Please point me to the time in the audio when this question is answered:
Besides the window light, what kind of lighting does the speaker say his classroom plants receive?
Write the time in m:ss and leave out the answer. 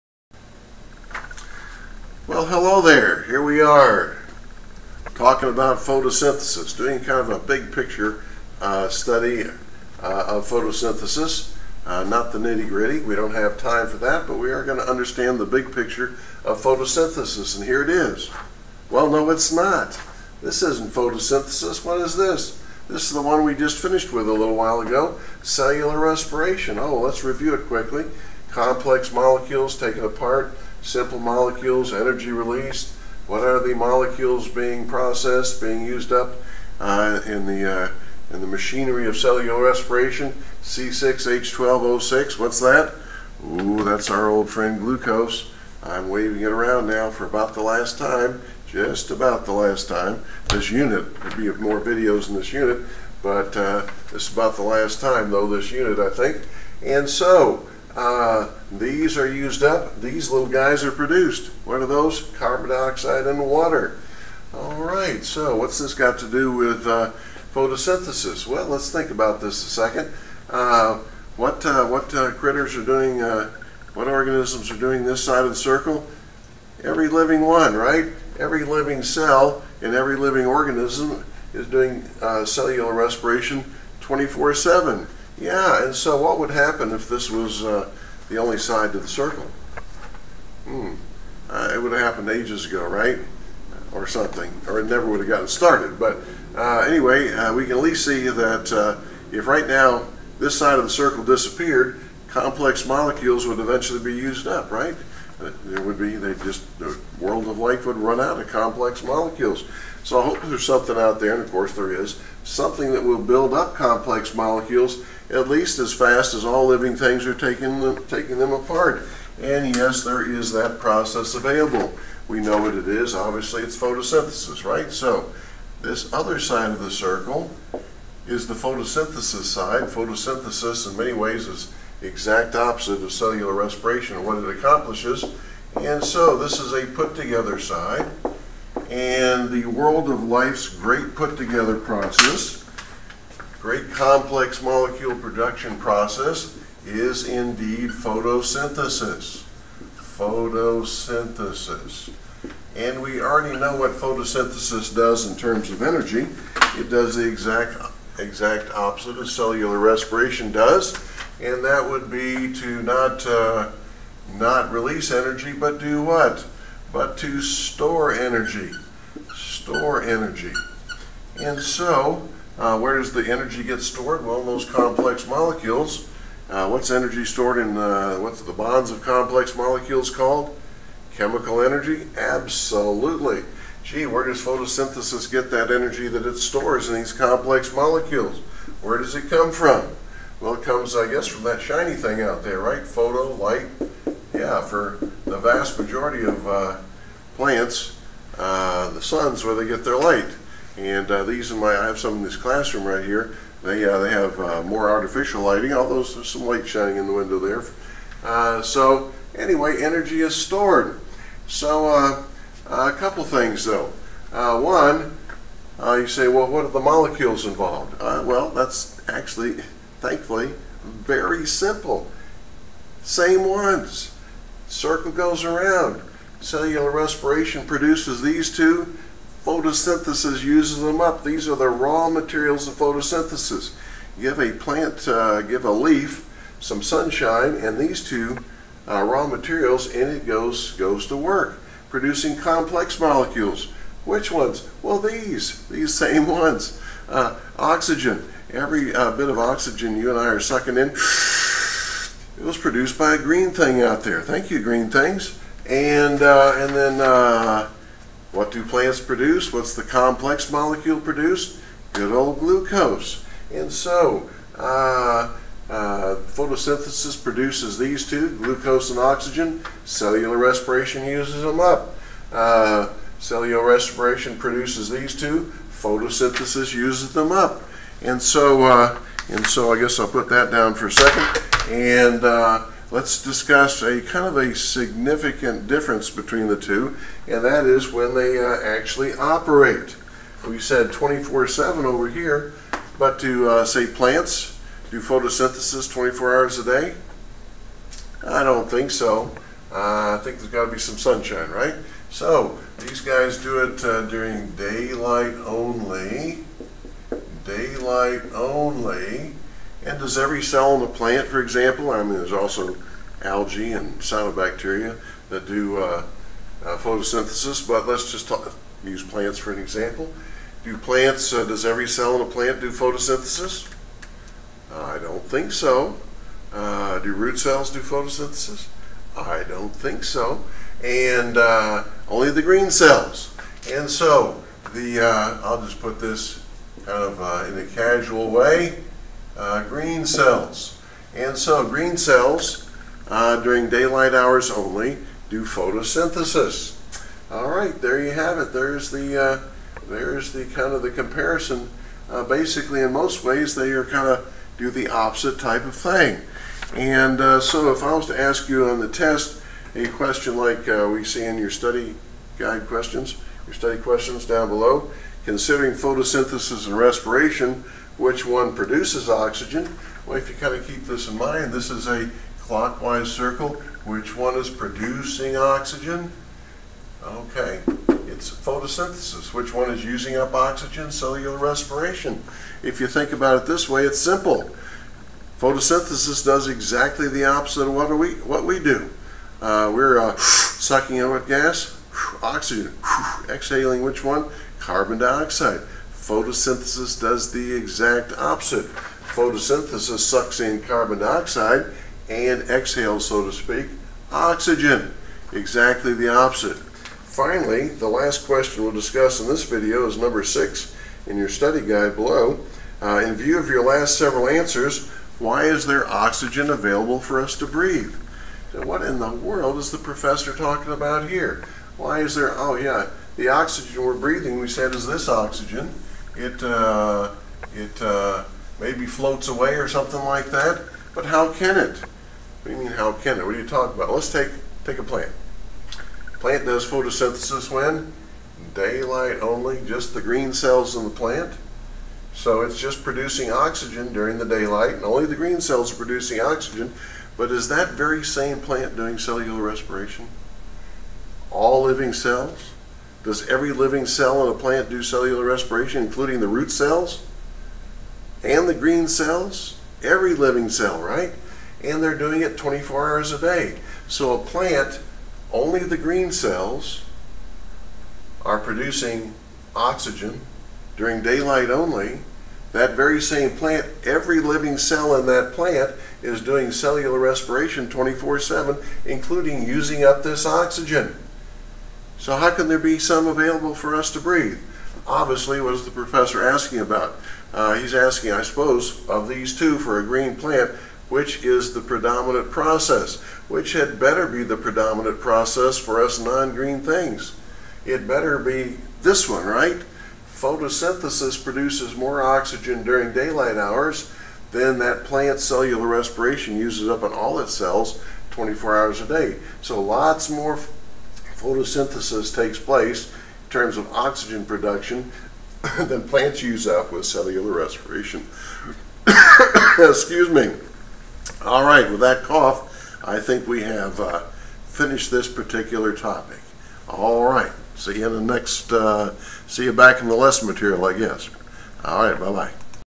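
3:24.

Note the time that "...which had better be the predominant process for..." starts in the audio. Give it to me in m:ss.
8:13.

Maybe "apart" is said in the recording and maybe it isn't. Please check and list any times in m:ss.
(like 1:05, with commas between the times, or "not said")
0:30, 1:58.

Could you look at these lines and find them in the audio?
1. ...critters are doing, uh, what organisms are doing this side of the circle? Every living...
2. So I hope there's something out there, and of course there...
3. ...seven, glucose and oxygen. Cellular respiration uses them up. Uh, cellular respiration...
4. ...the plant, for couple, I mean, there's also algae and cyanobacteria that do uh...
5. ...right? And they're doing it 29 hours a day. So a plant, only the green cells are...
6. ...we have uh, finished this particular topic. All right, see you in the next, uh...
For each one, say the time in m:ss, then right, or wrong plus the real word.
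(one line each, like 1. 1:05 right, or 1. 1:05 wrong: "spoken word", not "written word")
1. 1:12 right
2. 1:50 right
3. 4:28 wrong: "two", not "seven"
4. 5:10 wrong: "example", not "couple"
5. 7:40 wrong: "24", not "29"
6. 8:43 right.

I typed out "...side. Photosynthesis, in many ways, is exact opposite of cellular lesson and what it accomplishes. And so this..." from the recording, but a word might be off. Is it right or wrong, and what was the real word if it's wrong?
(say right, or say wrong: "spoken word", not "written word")
wrong: "respiration", not "lesson".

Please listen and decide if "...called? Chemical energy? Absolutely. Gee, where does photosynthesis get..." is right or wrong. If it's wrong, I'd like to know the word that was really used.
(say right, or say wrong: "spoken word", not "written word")
right.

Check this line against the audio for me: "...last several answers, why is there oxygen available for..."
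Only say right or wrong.
right.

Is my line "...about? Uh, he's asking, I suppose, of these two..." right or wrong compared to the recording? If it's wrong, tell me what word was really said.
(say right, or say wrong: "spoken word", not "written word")
right.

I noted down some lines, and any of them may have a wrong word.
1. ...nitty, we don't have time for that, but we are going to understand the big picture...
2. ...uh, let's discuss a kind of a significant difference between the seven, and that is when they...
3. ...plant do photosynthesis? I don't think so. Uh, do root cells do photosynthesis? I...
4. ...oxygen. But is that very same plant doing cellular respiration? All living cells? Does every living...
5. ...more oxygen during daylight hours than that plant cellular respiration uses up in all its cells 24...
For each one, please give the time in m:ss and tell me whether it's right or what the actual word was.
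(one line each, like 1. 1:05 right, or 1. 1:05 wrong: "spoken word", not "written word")
1. 0:12 wrong: "gritty", not "nitty"
2. 4:42 wrong: "two", not "seven"
3. 5:22 right
4. 7:26 right
5. 8:21 right.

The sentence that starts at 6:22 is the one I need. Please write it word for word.
If you think about it this way, it's simple.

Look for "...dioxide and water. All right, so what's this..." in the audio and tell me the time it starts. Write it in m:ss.
1:02.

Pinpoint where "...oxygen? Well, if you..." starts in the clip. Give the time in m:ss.
6:09.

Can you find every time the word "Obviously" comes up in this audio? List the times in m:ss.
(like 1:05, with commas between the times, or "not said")
2:03, 8:04.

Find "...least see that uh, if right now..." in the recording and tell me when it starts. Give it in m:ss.
1:37.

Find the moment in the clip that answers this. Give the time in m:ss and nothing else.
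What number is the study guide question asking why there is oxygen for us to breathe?
6:49.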